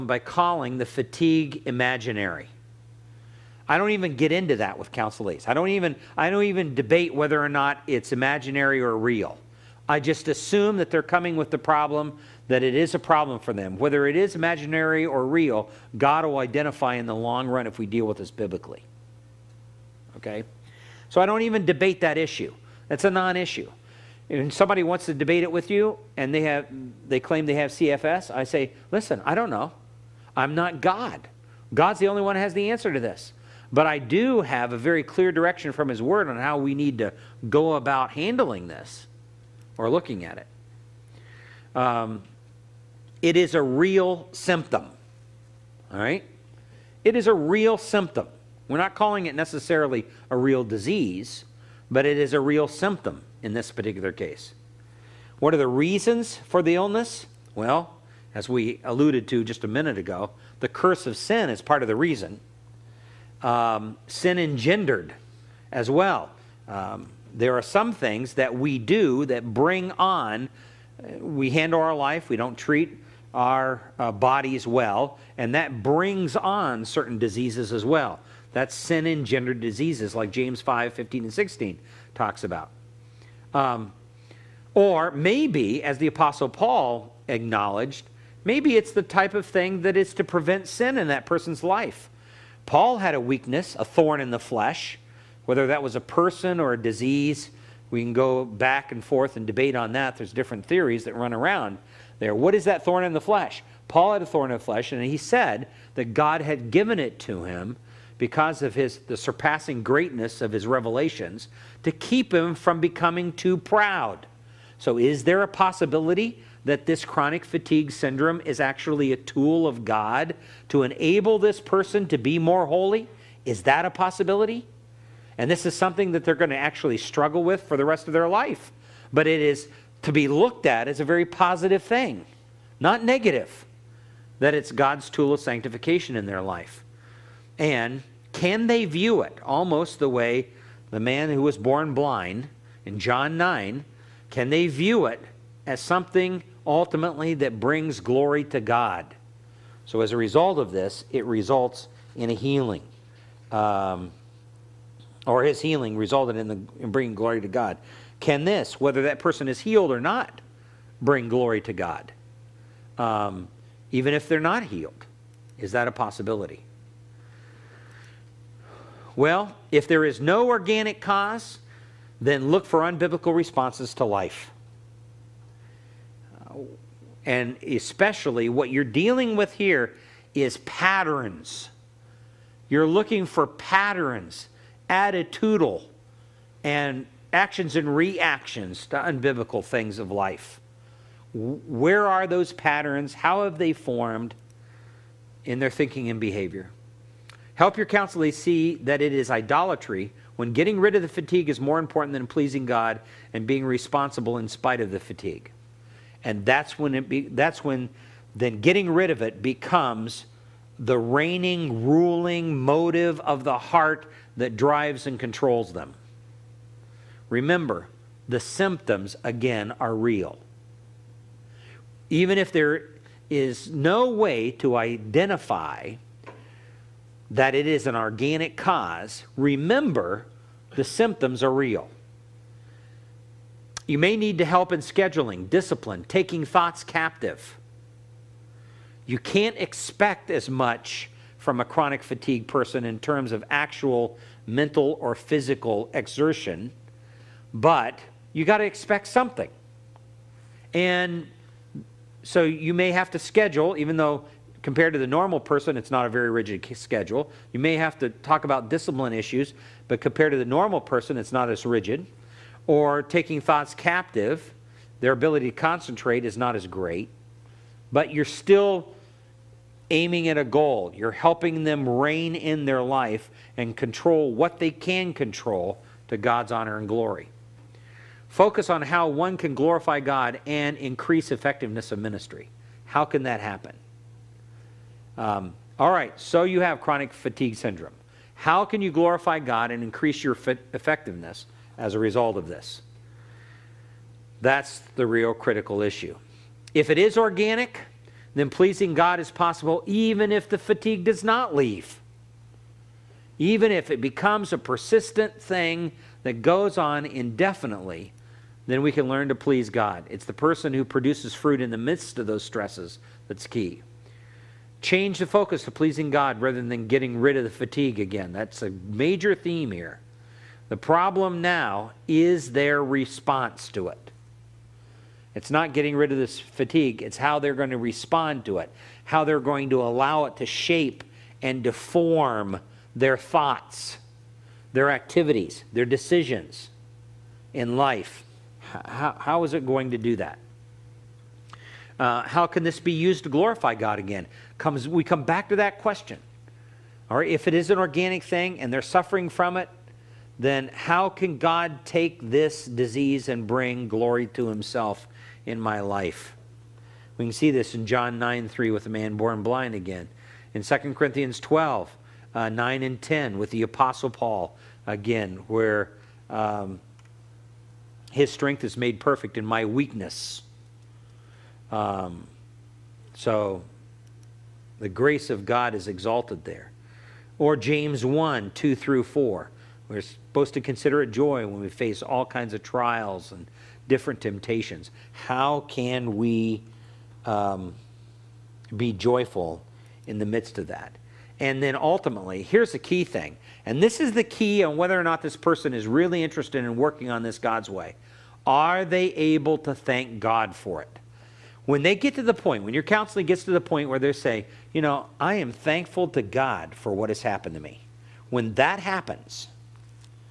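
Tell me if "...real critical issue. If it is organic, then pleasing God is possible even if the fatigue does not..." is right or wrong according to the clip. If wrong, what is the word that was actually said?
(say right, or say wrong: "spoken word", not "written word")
right.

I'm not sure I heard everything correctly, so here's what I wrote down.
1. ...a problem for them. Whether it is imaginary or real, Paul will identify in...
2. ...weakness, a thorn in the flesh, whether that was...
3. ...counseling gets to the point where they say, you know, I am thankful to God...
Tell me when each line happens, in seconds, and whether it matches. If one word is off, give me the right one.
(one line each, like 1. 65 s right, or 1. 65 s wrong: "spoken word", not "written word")
1. 12 s wrong: "God", not "Paul"
2. 93 s right
3. 402 s right.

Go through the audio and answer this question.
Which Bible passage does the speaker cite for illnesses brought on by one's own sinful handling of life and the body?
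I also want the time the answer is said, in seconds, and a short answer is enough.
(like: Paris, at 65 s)
James 5:15-16, at 80 s.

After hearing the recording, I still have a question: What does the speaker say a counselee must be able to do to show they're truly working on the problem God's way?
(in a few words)
Thank God for it.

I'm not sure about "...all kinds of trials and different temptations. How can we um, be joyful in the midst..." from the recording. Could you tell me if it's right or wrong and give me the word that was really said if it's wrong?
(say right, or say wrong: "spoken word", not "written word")
right.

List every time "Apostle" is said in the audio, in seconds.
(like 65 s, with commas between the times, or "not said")
86 s, 363 s.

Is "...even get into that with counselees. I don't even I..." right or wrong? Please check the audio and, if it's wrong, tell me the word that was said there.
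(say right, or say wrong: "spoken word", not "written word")
right.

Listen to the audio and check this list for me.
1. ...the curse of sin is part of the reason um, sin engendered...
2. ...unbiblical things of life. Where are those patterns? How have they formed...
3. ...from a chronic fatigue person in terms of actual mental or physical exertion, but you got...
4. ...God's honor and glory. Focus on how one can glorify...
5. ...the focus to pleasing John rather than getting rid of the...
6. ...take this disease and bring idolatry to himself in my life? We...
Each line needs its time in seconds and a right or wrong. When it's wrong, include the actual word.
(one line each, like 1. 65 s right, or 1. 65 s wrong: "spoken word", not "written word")
1. 60 s right
2. 188 s right
3. 241 s right
4. 276 s right
5. 315 s wrong: "God", not "John"
6. 351 s wrong: "glory", not "idolatry".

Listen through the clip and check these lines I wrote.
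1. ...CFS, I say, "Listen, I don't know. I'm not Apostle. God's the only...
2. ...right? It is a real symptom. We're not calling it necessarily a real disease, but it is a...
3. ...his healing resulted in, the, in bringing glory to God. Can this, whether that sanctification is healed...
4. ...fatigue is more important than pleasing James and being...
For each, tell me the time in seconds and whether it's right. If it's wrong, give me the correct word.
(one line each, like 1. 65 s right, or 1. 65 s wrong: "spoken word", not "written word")
1. 27 s wrong: "God", not "Apostle"
2. 45 s right
3. 155 s wrong: "person", not "sanctification"
4. 201 s wrong: "God", not "James".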